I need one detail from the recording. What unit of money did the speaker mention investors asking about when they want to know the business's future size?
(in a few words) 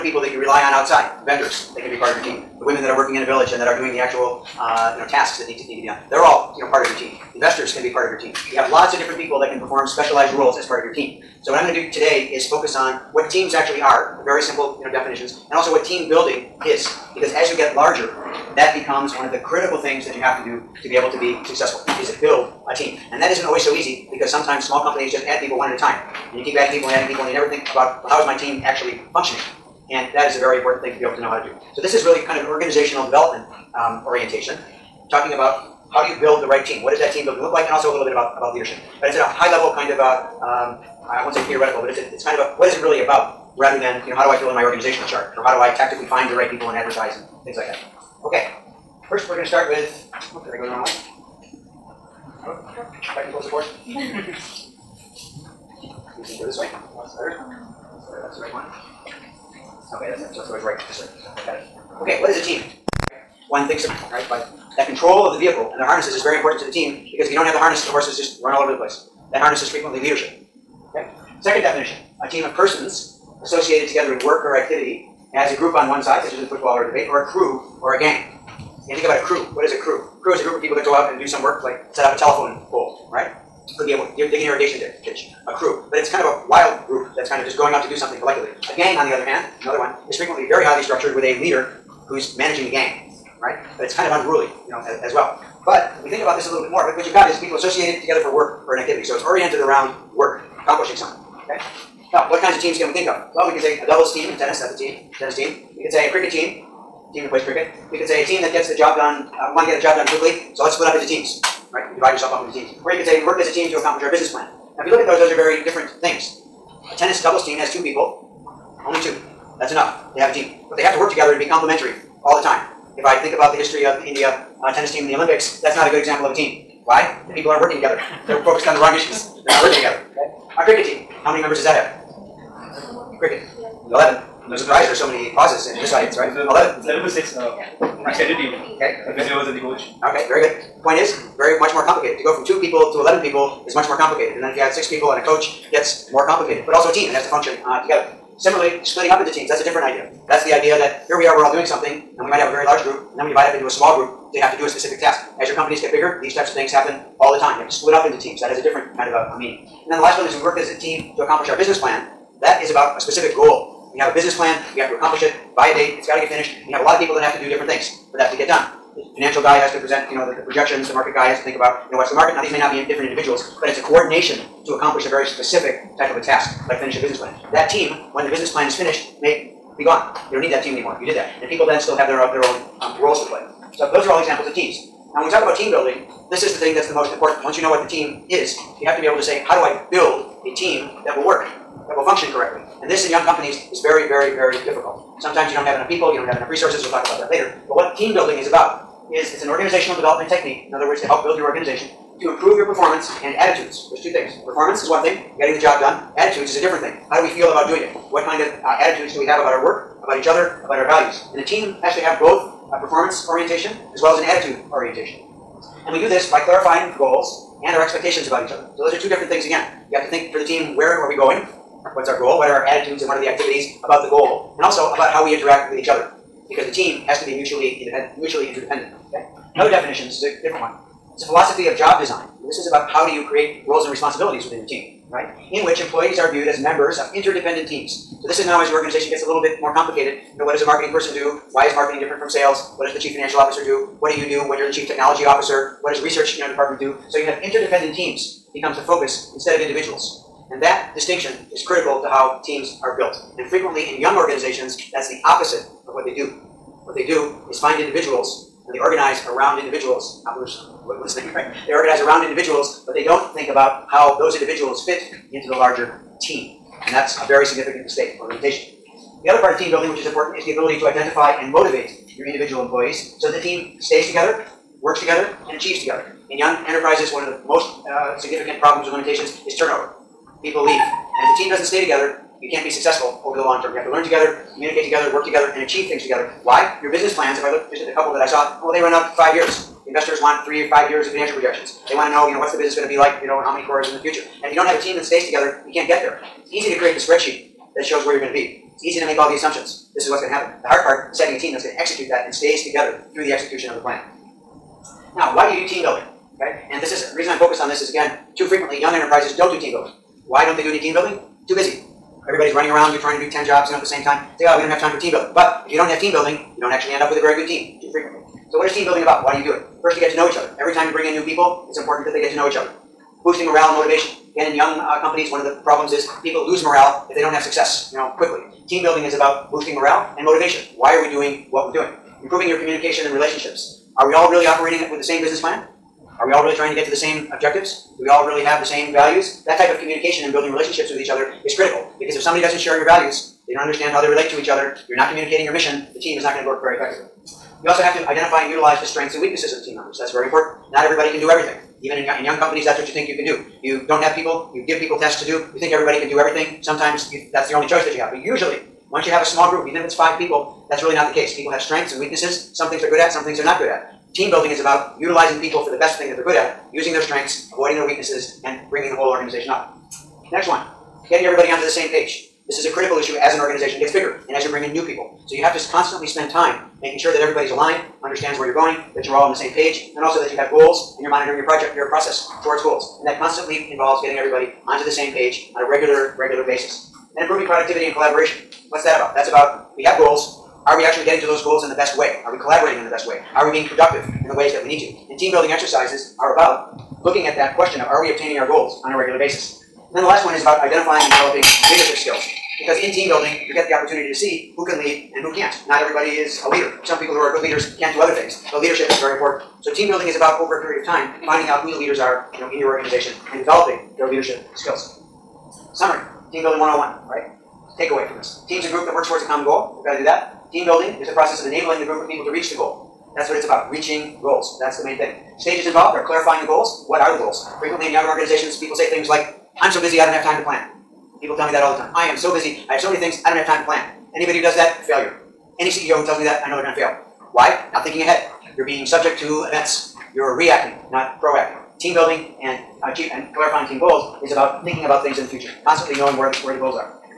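crores.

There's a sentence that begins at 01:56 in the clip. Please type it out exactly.
A tennis doubles team has two people, only two.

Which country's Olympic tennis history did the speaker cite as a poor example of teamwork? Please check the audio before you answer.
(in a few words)
India.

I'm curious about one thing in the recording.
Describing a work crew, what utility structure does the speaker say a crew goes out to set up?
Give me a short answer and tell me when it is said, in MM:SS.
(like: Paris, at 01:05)
telephone pole, at 01:22.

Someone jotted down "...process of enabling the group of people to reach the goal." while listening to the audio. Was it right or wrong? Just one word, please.
right.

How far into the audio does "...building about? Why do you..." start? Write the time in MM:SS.
05:18.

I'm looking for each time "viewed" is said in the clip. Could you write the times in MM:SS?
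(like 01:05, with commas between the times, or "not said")
03:56.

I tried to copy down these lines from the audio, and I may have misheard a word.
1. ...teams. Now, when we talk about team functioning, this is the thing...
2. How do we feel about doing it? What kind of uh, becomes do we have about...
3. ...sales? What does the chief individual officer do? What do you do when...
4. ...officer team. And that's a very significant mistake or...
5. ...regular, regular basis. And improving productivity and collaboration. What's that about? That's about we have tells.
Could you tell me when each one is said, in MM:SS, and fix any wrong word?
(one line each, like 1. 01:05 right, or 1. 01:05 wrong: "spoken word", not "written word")
1. 03:04 wrong: "building", not "functioning"
2. 03:27 wrong: "attitudes", not "becomes"
3. 04:02 wrong: "financial", not "individual"
4. 04:25 wrong: "larger", not "officer"
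5. 06:25 wrong: "goals", not "tells".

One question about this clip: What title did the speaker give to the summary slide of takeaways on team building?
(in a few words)
Team Building 101.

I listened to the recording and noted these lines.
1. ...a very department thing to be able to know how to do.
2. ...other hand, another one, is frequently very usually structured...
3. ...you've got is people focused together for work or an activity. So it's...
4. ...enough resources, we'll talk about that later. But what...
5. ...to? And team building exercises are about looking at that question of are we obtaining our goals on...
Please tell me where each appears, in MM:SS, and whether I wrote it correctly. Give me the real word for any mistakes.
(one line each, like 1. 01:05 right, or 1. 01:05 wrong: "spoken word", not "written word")
1. 00:30 wrong: "important", not "department"
2. 01:29 wrong: "highly", not "usually"
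3. 01:37 wrong: "associated", not "focused"
4. 03:16 right
5. 06:34 right.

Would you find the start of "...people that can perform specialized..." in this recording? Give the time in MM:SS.
00:09.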